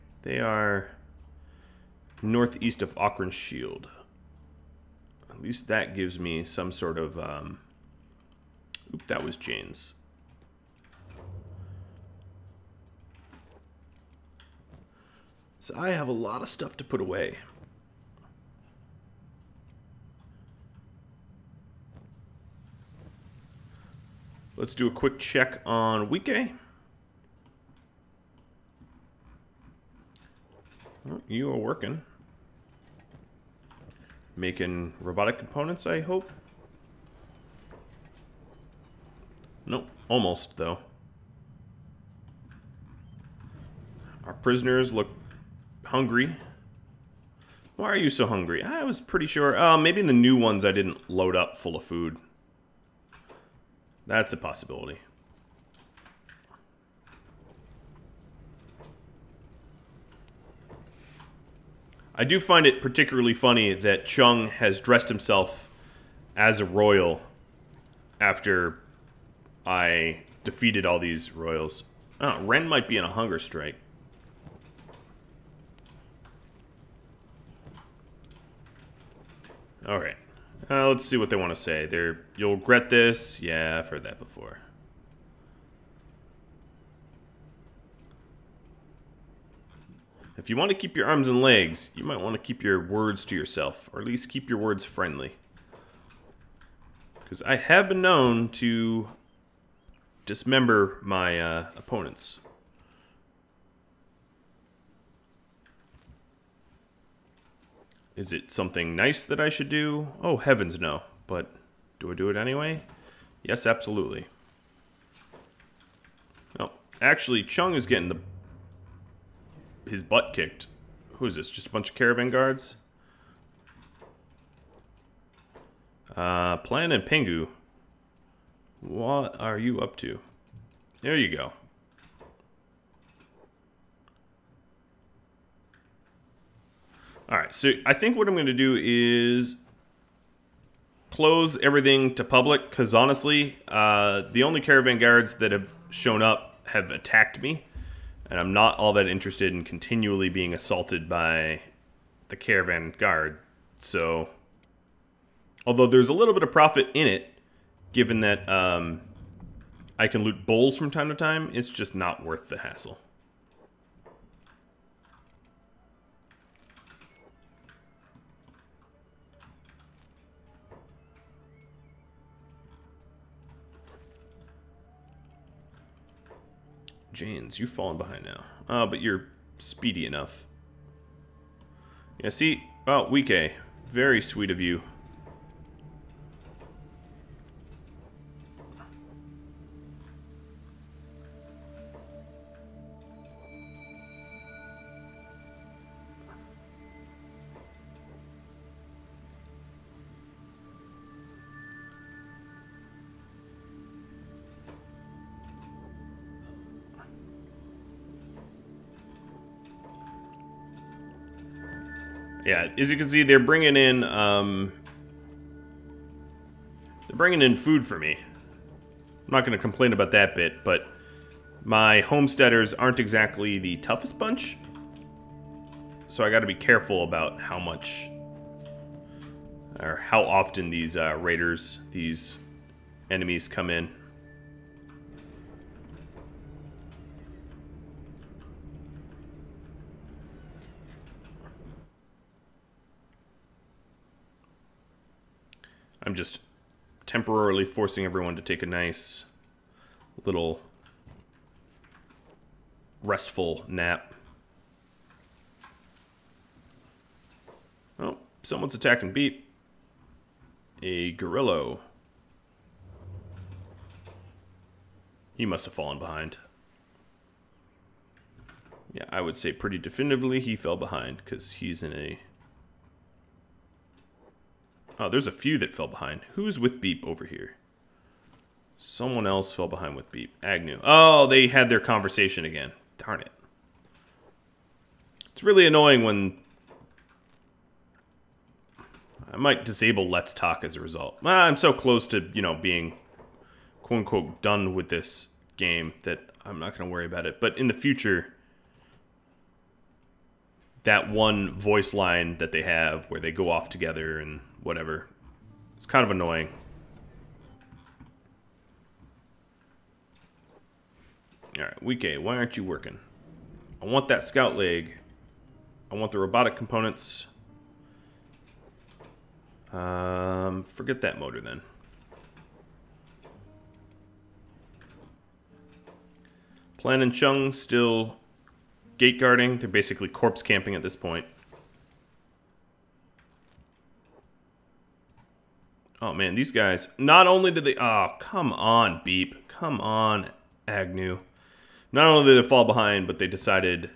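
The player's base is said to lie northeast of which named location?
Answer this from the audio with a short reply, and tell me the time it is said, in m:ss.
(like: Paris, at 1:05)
Okran Shield, at 0:02.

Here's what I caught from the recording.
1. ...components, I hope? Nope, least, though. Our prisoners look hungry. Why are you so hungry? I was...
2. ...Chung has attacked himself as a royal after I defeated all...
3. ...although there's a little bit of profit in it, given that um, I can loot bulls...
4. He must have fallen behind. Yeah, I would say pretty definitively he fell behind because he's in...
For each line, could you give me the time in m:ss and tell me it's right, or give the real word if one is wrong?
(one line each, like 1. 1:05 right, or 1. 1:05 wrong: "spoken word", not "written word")
1. 0:35 wrong: "almost", not "least"
2. 1:04 wrong: "dressed", not "attacked"
3. 2:35 right
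4. 4:25 right.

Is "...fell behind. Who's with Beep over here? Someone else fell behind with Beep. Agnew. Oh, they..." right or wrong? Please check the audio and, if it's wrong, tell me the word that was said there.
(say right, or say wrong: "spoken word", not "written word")
right.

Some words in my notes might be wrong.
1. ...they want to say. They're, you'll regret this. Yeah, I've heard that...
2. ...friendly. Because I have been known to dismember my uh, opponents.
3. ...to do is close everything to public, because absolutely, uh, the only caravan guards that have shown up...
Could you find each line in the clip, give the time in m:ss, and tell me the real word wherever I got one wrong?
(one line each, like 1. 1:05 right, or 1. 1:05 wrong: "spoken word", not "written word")
1. 1:21 right
2. 1:34 right
3. 2:18 wrong: "honestly", not "absolutely".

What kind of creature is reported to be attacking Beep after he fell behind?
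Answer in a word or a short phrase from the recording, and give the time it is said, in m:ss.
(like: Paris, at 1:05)
A gorillo, at 4:20.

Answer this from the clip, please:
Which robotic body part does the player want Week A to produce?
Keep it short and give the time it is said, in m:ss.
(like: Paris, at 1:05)
Scout leg, at 5:14.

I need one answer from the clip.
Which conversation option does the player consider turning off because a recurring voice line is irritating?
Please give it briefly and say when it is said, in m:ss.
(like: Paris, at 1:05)
Let's Talk, at 4:50.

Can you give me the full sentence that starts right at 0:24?
Let's do a quick check on Week A.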